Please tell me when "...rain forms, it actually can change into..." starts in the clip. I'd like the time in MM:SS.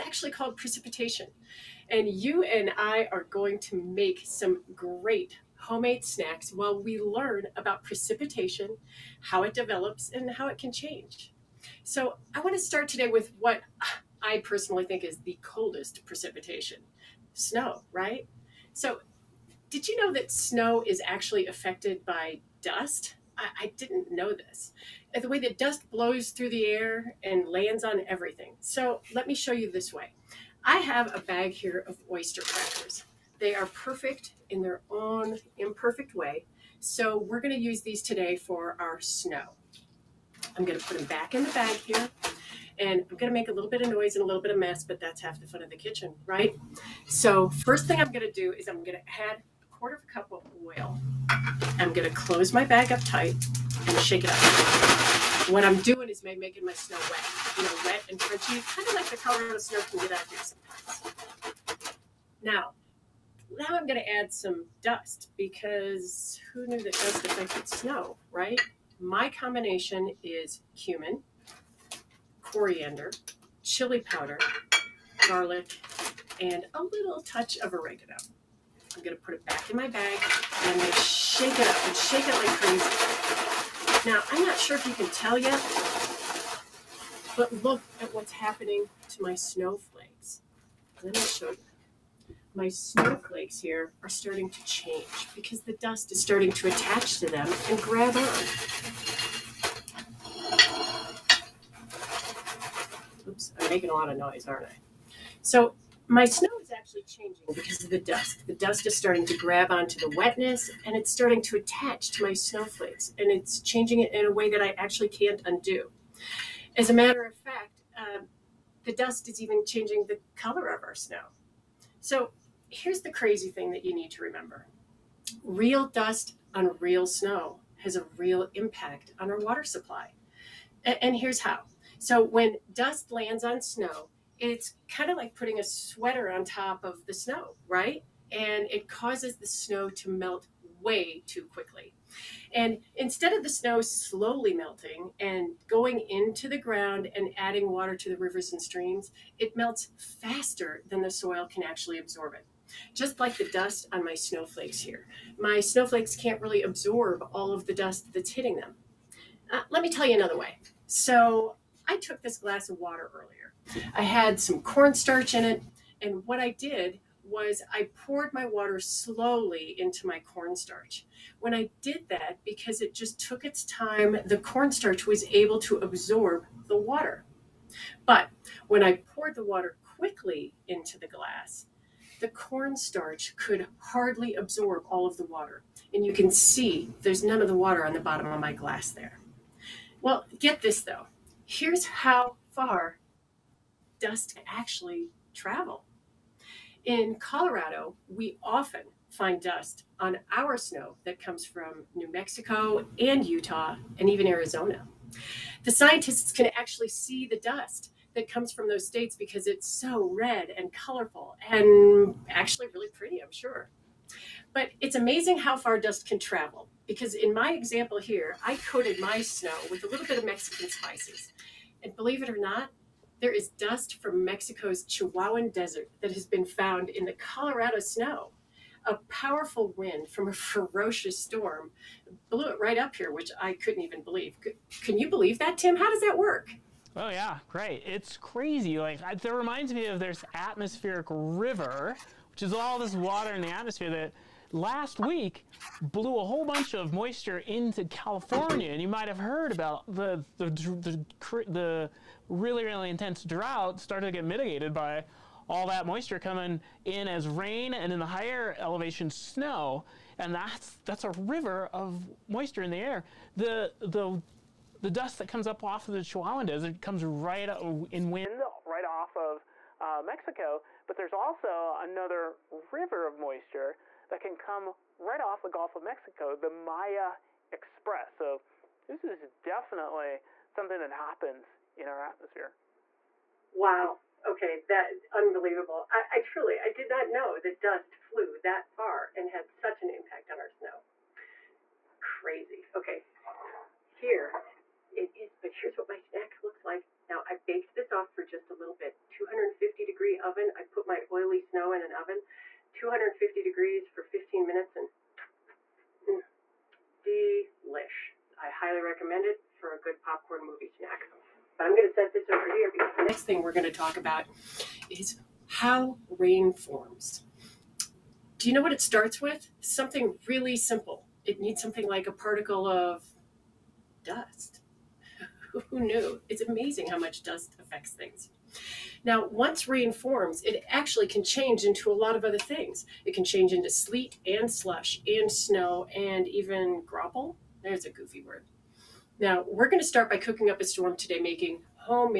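05:29.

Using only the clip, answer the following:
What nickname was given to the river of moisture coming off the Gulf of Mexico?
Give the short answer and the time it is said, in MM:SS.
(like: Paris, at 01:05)
the Maya Express, at 04:36.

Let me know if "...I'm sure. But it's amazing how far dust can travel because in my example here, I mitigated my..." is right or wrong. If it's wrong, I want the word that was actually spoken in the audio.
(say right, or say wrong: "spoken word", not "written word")
wrong: "coated", not "mitigated".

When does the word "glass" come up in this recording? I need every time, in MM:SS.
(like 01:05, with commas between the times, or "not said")
02:42, 03:01, 03:08.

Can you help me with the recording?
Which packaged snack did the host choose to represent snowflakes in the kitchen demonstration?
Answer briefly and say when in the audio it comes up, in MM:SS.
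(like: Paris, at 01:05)
oyster crackers, at 00:32.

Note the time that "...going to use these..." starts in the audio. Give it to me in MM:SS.
00:37.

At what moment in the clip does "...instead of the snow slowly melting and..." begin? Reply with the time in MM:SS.
02:22.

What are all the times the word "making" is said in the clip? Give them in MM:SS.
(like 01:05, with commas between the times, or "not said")
00:56, 01:43, 05:41.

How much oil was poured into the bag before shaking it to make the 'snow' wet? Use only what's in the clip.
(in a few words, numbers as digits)
a quarter of a cup.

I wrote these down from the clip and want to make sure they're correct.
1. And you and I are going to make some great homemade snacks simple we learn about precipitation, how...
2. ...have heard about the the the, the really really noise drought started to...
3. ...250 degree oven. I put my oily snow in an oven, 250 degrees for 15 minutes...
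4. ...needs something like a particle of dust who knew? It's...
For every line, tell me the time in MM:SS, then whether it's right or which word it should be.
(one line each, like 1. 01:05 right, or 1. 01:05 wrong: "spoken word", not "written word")
1. 00:01 wrong: "while", not "simple"
2. 04:09 wrong: "intense", not "noise"
3. 04:59 right
4. 05:21 right.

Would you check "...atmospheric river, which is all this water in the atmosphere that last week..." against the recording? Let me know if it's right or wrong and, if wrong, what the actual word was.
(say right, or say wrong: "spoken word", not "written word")
right.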